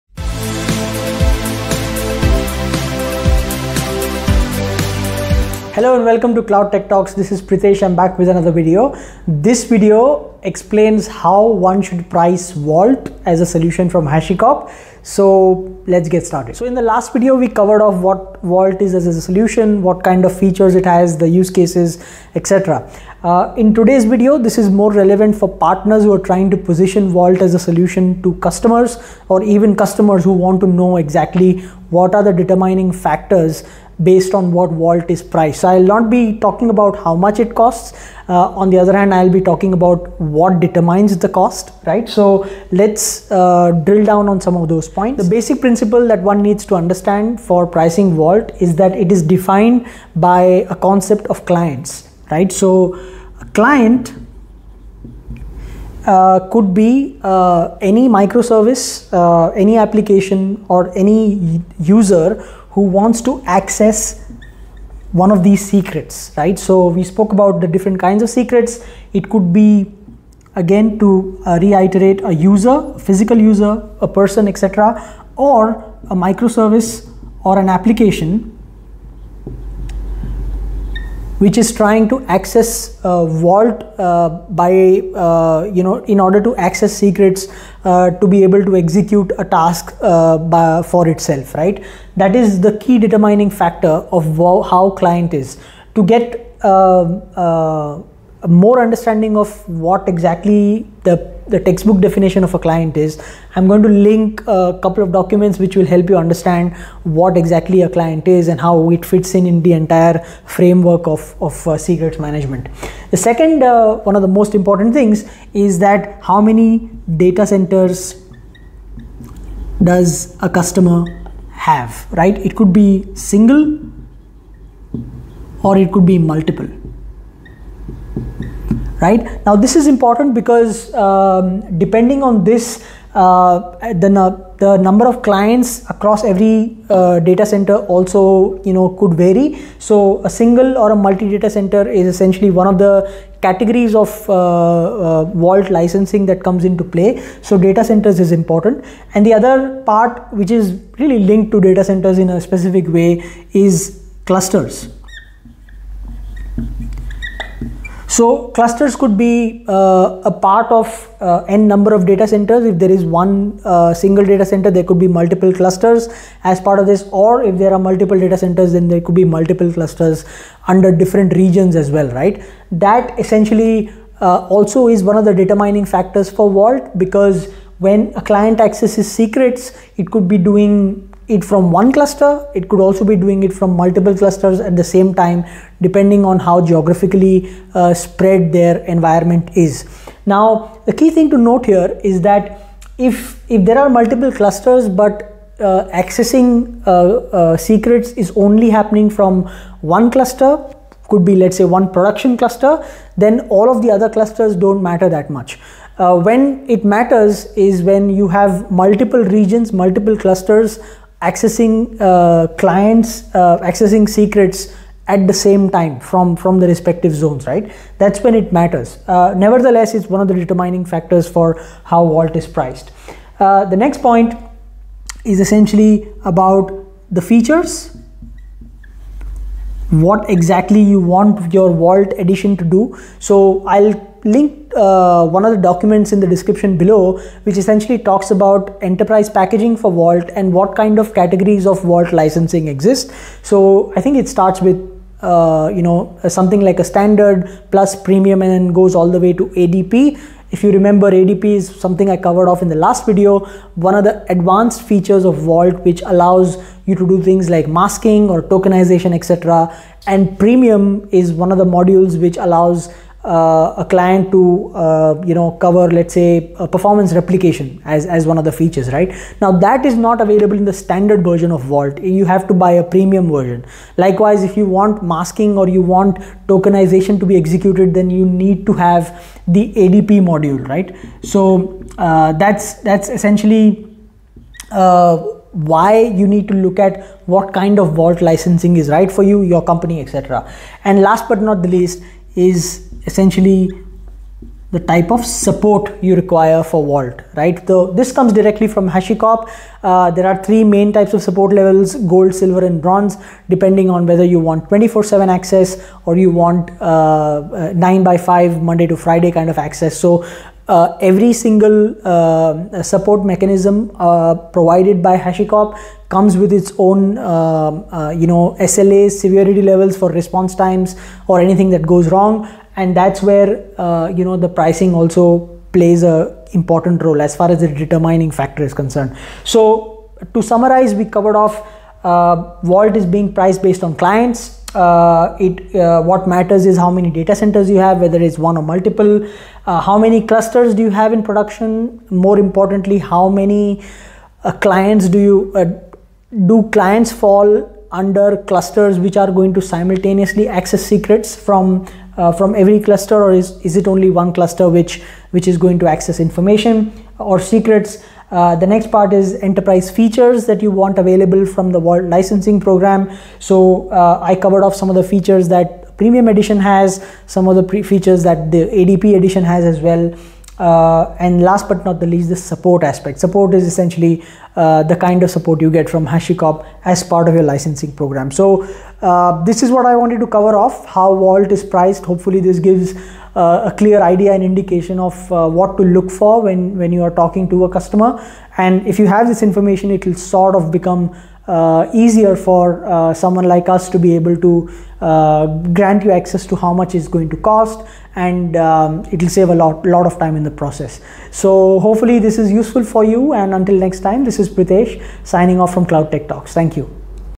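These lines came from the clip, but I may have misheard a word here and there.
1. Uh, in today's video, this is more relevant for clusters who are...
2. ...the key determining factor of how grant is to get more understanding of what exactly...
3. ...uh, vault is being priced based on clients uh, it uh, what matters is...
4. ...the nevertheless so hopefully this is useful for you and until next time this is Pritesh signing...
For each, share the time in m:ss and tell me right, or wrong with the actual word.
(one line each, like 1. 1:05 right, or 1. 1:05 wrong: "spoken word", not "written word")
1. 0:23 wrong: "partners", not "clusters"
2. 1:32 wrong: "client", not "grant"
3. 5:32 right
4. 6:40 wrong: "process", not "nevertheless".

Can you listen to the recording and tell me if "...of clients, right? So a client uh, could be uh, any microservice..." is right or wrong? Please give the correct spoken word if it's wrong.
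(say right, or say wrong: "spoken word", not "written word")
right.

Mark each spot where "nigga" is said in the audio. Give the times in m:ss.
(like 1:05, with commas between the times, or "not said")
not said.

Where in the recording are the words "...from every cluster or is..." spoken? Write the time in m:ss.
5:52.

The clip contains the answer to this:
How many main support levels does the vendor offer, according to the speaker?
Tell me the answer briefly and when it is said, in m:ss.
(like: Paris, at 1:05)
3, at 5:00.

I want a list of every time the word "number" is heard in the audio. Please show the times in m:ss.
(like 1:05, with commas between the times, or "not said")
2:14, 2:41.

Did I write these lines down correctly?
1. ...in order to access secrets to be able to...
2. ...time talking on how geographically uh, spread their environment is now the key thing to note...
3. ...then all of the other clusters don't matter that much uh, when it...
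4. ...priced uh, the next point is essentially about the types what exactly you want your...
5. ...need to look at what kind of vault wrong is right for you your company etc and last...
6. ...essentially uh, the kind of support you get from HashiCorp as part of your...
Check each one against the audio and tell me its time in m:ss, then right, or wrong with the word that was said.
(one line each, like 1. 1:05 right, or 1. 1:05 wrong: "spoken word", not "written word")
1. 1:26 right
2. 3:05 wrong: "depending", not "talking"
3. 3:23 right
4. 3:42 wrong: "features", not "types"
5. 4:46 wrong: "licensing", not "wrong"
6. 6:13 right.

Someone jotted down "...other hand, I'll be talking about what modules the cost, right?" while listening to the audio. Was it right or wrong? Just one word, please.
wrong.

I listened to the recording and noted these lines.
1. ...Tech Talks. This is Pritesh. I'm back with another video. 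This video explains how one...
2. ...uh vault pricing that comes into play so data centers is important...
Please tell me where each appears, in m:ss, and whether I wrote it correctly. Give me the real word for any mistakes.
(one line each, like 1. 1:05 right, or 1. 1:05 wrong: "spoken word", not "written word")
1. 0:06 right
2. 2:24 wrong: "licensing", not "pricing".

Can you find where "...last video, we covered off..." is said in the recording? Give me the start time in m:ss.
0:16.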